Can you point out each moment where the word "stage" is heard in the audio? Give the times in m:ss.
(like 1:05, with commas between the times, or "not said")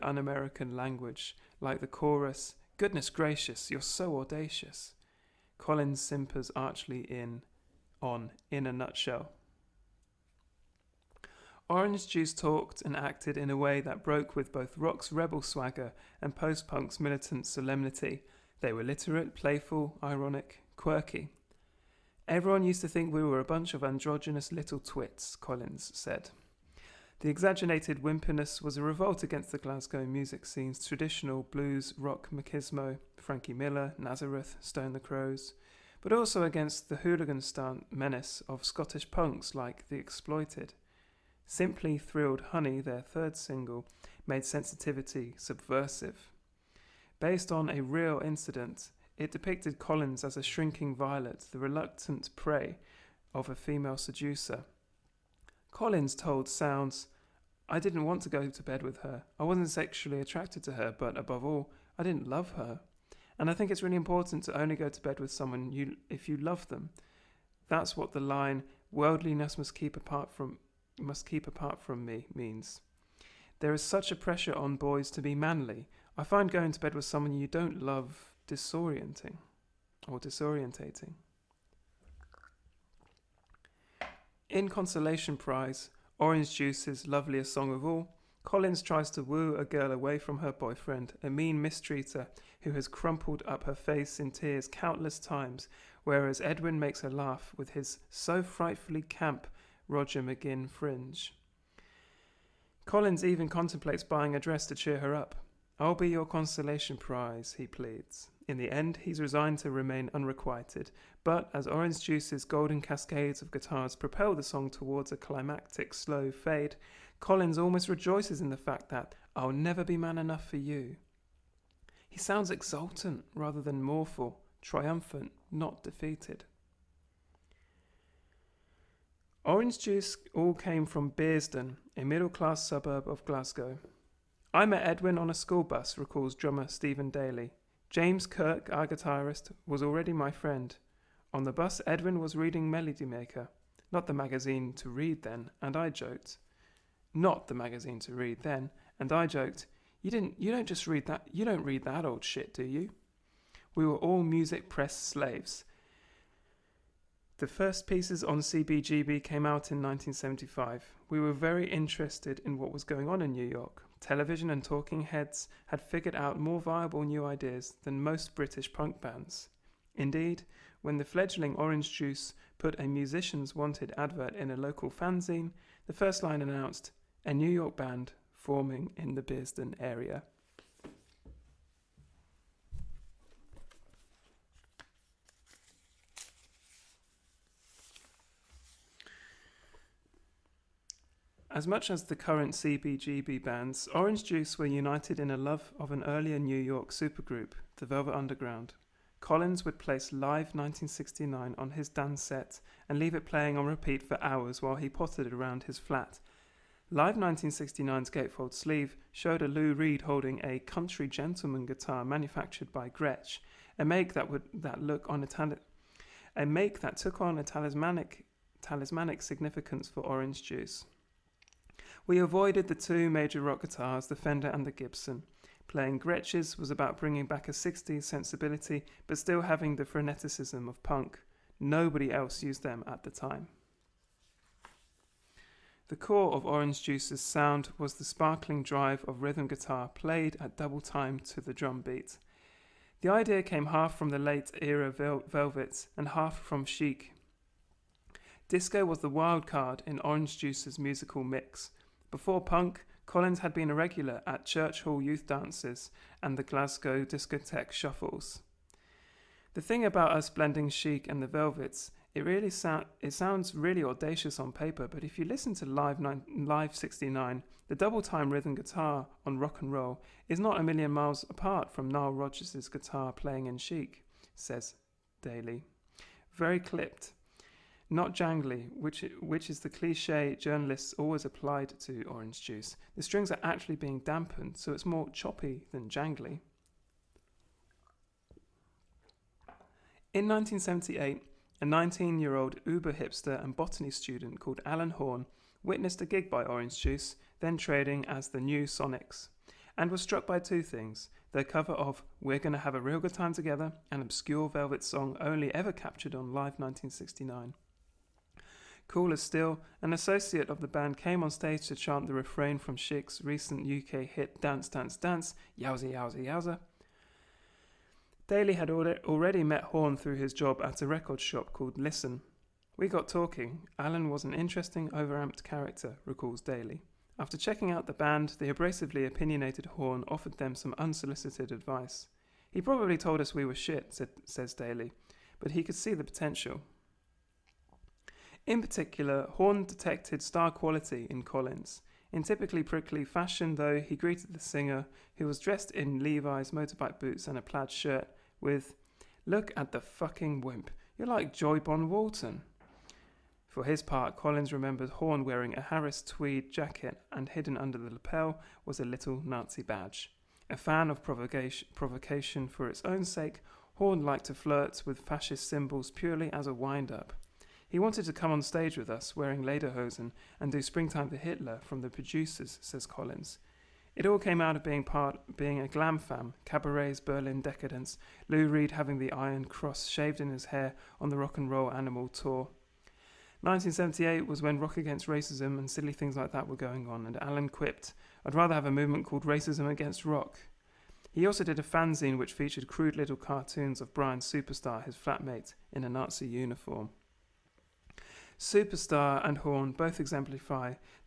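5:11, 6:08.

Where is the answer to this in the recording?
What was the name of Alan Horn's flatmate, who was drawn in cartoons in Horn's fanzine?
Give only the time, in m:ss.
6:33.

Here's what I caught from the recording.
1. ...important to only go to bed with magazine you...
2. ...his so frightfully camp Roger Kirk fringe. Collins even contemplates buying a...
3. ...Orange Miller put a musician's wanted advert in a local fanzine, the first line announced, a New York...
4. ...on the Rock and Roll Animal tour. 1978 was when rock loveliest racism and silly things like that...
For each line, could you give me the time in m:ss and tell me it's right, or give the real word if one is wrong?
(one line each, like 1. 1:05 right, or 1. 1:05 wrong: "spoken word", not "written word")
1. 1:03 wrong: "someone", not "magazine"
2. 1:37 wrong: "McGuinn", not "Kirk"
3. 2:51 wrong: "Juice", not "Miller"
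4. 6:21 wrong: "against", not "loveliest".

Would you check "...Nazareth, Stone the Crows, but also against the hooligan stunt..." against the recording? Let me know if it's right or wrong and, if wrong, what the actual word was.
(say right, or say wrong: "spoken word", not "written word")
right.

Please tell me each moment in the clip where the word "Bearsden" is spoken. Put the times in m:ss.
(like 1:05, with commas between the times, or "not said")
2:11, 2:59.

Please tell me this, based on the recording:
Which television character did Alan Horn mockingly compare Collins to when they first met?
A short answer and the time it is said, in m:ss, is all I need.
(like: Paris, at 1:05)
John Boy Walton, at 5:51.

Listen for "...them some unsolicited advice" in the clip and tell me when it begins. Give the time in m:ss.
5:30.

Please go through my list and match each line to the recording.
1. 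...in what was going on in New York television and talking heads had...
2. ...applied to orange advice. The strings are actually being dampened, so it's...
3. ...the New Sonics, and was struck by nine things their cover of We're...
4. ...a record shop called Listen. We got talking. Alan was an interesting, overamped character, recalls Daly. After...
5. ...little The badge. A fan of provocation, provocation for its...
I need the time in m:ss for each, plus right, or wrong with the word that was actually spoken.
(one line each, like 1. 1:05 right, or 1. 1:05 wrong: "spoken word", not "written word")
1. 2:42 right
2. 4:41 wrong: "juice", not "advice"
3. 4:58 wrong: "two", not "nine"
4. 5:20 right
5. 5:58 wrong: "Nazi", not "The".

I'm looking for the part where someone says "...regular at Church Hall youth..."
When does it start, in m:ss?
4:13.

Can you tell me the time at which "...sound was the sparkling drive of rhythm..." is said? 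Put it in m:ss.
3:57.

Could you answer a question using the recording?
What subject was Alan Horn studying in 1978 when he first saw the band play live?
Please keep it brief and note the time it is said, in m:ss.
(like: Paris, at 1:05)
Botany, at 4:53.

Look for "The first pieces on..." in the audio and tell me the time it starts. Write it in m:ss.
2:37.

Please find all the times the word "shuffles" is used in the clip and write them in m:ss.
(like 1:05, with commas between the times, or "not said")
4:17.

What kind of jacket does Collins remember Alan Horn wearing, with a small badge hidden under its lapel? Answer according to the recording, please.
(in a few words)
Harris tweed.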